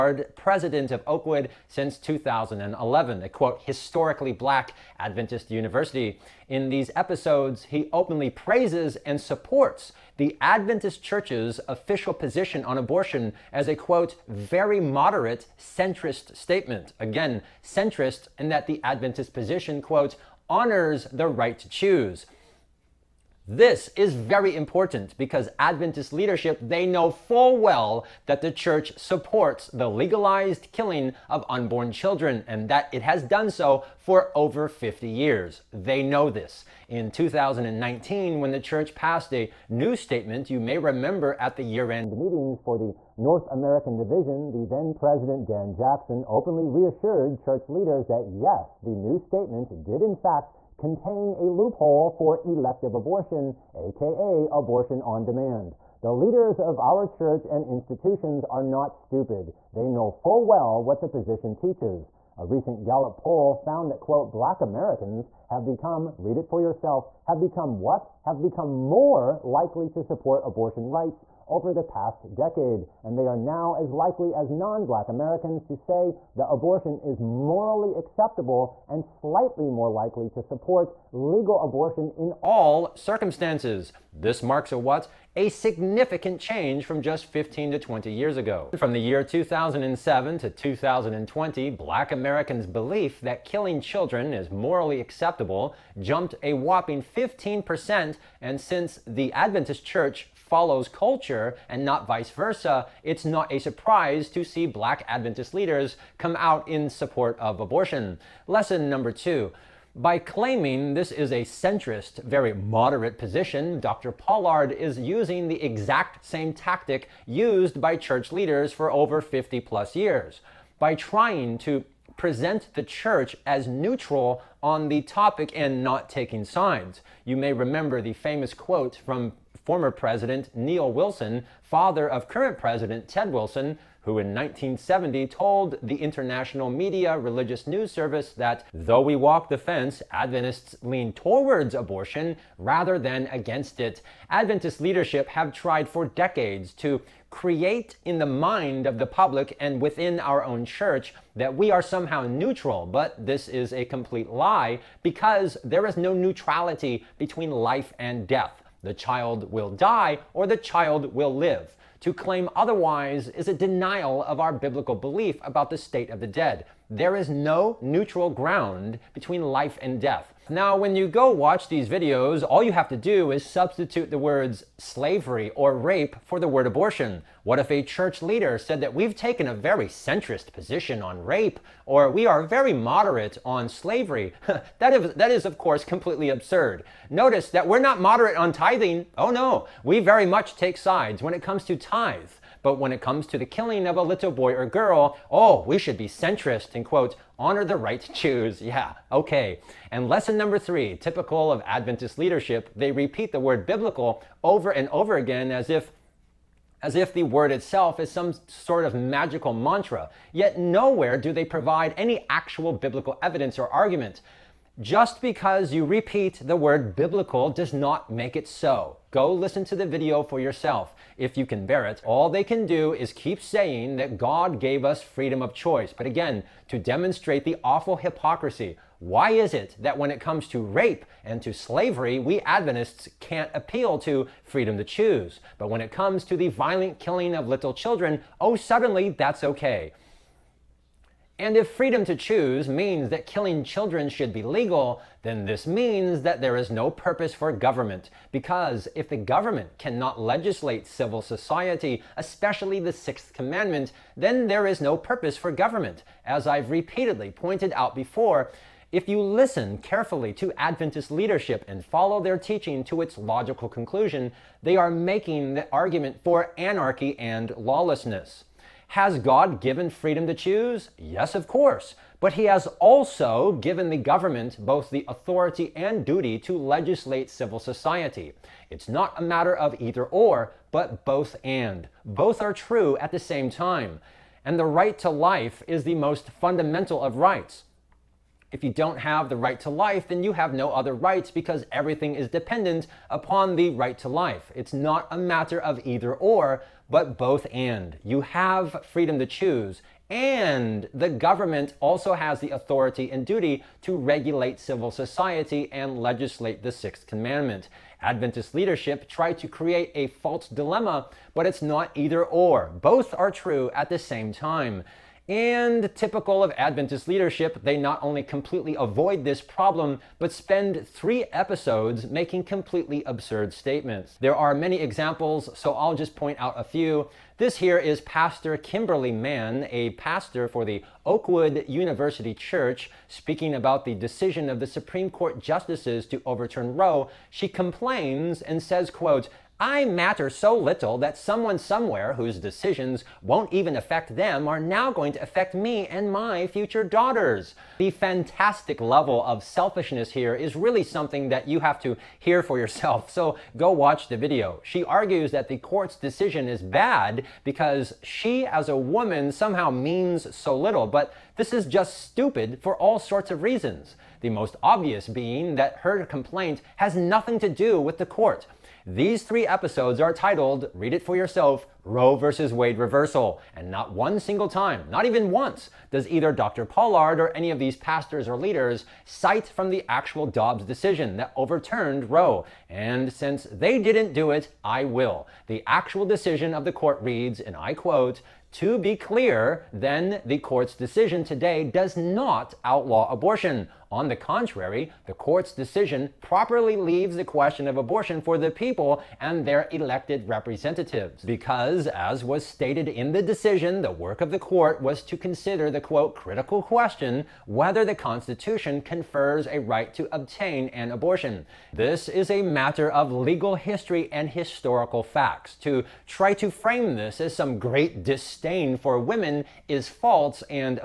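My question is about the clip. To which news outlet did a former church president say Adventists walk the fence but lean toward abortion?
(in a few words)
religious news service.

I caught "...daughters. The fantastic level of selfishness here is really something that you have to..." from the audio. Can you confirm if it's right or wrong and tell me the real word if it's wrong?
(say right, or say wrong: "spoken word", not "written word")
right.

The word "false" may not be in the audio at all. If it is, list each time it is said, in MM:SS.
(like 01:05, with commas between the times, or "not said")
05:10, 06:59.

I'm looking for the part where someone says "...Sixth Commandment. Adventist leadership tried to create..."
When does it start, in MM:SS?
05:06.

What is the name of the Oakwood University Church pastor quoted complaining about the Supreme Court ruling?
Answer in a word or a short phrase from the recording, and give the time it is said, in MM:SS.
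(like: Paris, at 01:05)
Kimberly Mann, at 05:28.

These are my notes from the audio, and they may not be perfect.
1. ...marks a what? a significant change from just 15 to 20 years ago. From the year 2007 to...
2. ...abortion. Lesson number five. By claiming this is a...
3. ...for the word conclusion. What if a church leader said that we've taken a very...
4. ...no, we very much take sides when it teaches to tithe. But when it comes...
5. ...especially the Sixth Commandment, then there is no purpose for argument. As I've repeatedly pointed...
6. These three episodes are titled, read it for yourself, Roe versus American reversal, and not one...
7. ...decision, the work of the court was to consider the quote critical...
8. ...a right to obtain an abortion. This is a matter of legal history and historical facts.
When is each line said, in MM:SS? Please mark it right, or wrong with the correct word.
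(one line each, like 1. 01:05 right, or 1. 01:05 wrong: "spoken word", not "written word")
1. 01:24 right
2. 01:47 wrong: "two", not "five"
3. 02:56 wrong: "abortion", not "conclusion"
4. 03:09 wrong: "comes", not "teaches"
5. 04:12 wrong: "government", not "argument"
6. 06:08 wrong: "Wade", not "American"
7. 06:43 right
8. 06:49 right.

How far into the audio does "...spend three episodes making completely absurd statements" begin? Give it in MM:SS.
05:20.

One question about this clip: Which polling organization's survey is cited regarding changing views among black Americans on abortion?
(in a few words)
Gallup.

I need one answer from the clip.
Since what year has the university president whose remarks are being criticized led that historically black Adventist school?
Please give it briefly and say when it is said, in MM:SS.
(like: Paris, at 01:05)
2011, at 00:01.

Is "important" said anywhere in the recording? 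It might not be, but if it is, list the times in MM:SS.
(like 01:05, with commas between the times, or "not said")
00:24.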